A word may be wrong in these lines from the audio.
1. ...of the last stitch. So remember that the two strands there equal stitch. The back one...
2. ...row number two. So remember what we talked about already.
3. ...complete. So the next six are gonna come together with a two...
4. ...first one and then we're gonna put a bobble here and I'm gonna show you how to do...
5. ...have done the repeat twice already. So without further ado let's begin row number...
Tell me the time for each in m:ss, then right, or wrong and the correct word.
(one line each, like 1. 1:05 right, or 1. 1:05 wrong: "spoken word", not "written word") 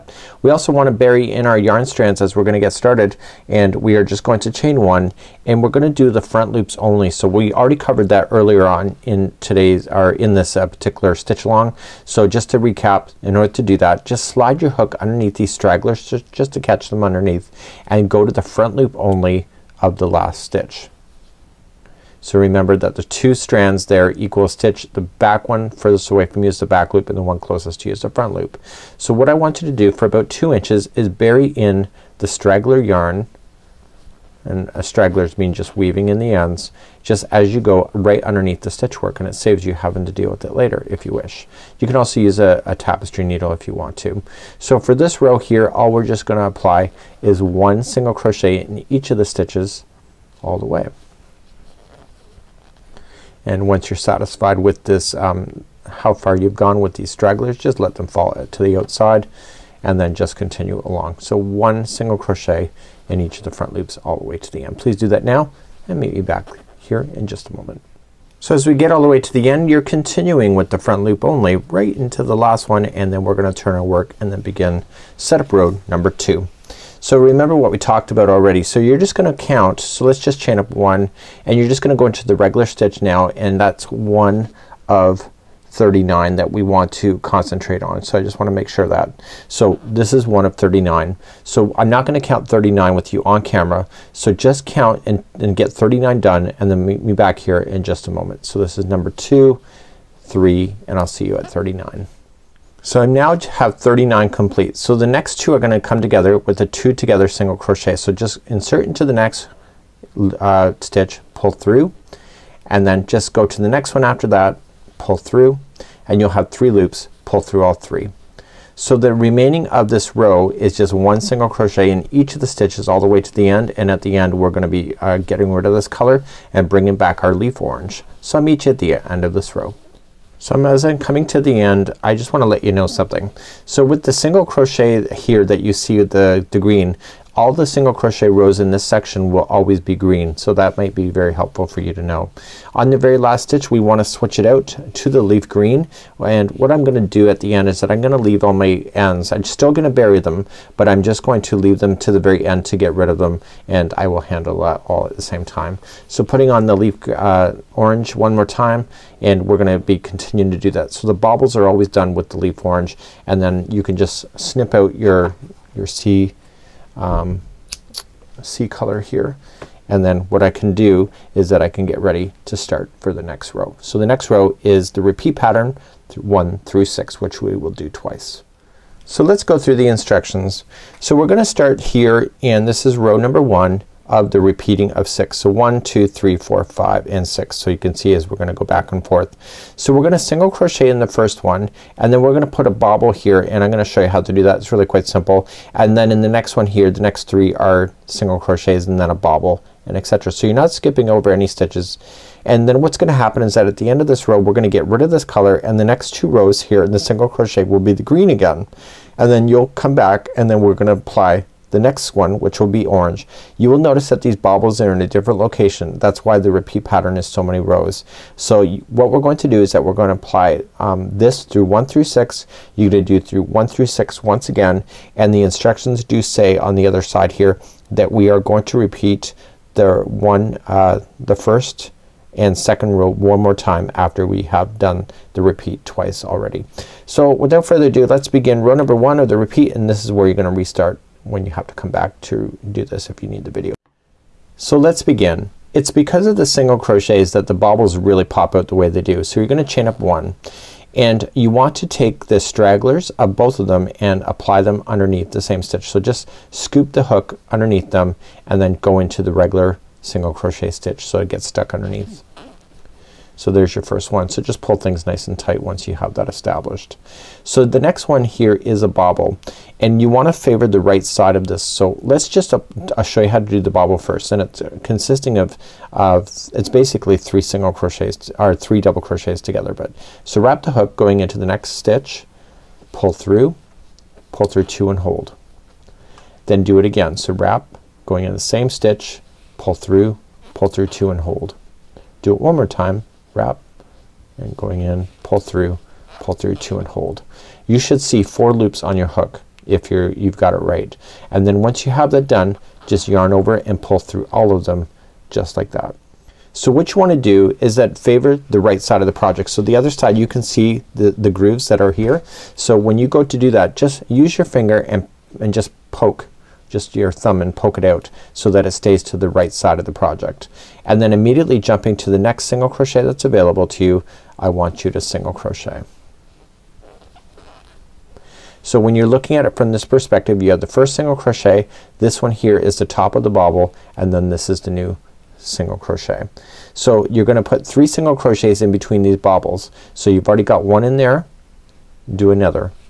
1. 0:19 right
2. 1:15 right
3. 1:44 wrong: "two", not "six"
4. 3:11 right
5. 3:54 right.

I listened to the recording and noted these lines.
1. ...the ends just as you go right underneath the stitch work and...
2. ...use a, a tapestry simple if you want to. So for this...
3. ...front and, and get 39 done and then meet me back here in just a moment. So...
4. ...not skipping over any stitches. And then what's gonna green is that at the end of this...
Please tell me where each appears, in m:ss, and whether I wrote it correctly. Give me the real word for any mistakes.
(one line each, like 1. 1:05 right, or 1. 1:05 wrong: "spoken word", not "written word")
1. 0:36 right
2. 0:42 wrong: "needle", not "simple"
3. 1:34 wrong: "count", not "front"
4. 3:20 wrong: "happen", not "green".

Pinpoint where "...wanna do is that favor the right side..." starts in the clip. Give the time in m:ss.
5:07.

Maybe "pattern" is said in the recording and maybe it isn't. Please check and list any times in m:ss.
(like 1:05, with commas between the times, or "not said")
2:55, 3:36.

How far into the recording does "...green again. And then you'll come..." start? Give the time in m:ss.
3:28.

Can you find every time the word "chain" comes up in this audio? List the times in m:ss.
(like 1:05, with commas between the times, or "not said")
0:04, 1:20, 4:09.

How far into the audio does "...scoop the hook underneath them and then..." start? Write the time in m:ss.
4:16.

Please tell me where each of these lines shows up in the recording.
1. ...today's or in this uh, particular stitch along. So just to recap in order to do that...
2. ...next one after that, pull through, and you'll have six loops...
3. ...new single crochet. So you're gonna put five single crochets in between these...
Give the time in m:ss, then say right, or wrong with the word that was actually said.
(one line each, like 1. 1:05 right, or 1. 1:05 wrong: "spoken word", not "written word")
1. 0:09 right
2. 1:53 wrong: "three", not "six"
3. 5:34 wrong: "three", not "five".